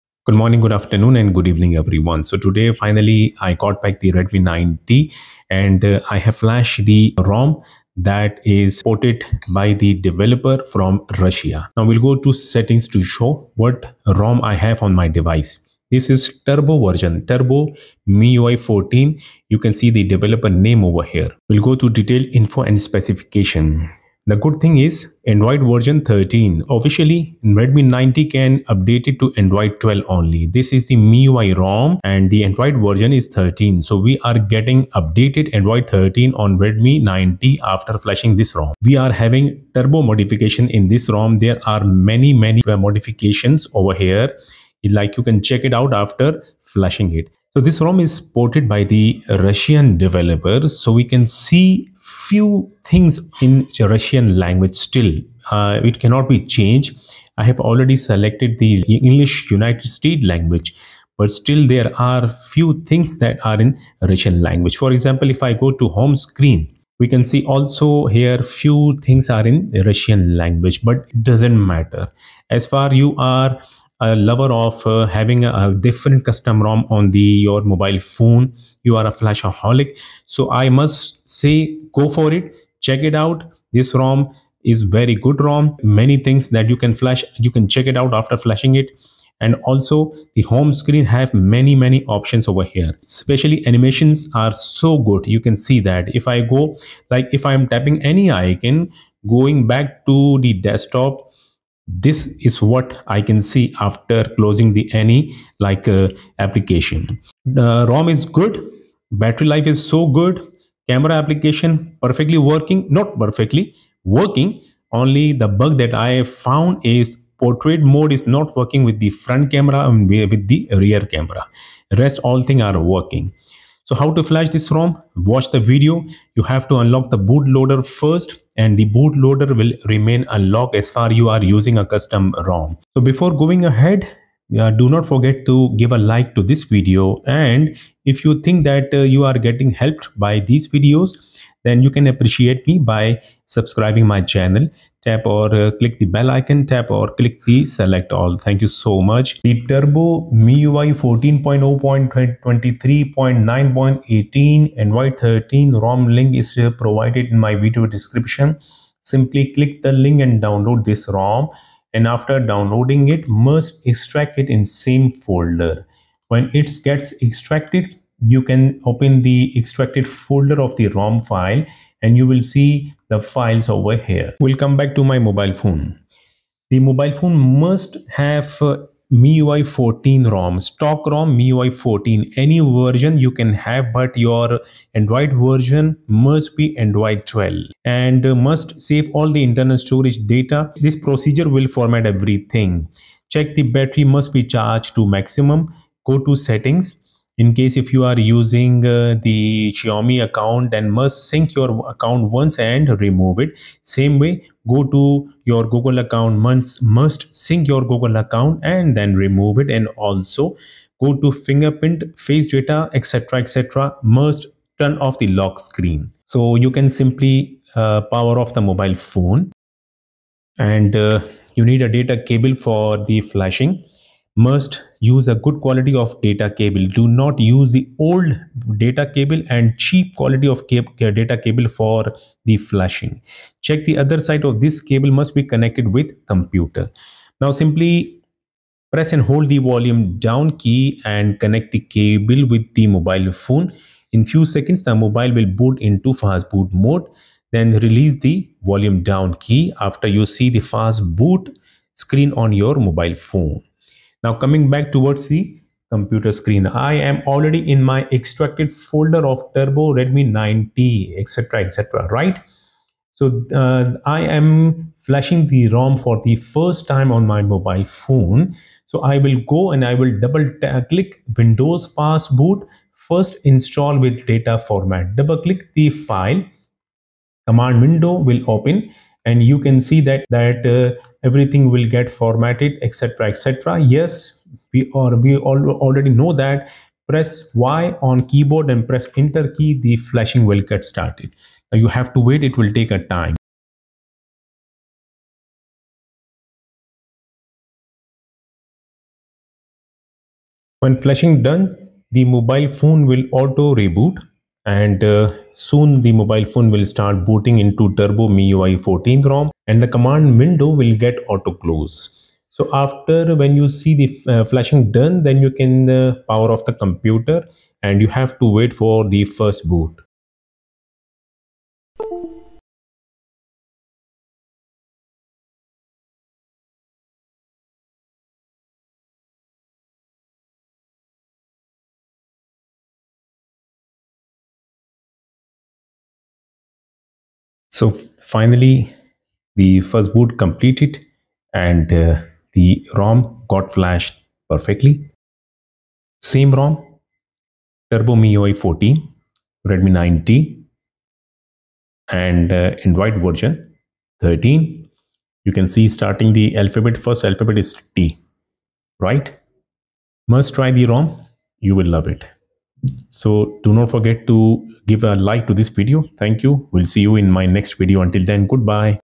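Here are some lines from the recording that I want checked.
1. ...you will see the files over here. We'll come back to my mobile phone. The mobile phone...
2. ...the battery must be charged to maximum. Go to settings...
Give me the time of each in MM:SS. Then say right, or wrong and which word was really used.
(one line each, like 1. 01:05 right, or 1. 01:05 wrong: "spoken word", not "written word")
1. 02:52 right
2. 03:13 right.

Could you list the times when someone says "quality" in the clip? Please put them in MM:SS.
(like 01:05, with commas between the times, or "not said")
03:45, 03:50.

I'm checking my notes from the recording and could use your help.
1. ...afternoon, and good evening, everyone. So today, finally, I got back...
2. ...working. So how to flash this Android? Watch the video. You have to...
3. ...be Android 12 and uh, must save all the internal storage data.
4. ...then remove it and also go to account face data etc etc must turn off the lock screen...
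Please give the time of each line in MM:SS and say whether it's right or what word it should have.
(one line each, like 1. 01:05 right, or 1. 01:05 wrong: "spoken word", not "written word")
1. 00:00 right
2. 02:02 wrong: "ROM", not "Android"
3. 03:06 right
4. 03:28 wrong: "fingerprint", not "account".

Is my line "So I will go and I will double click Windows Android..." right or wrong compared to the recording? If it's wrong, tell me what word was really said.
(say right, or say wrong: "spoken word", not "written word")
wrong: "Fast", not "Android".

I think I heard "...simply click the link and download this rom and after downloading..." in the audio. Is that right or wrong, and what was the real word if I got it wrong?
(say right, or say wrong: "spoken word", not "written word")
right.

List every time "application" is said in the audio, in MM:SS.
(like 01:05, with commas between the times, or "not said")
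01:46, 01:51.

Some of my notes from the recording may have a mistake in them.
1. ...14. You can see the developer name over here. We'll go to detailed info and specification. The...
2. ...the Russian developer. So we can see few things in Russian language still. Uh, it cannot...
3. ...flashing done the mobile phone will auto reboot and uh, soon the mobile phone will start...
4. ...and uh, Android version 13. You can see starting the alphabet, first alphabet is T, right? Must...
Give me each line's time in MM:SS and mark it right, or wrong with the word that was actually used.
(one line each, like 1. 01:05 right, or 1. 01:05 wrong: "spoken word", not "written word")
1. 00:18 right
2. 00:48 right
3. 05:00 right
4. 05:52 right.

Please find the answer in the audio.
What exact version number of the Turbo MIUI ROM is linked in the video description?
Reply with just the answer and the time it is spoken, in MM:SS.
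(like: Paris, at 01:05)
14.0.23.9.18, at 02:31.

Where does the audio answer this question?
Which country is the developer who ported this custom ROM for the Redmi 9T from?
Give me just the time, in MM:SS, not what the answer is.
00:11.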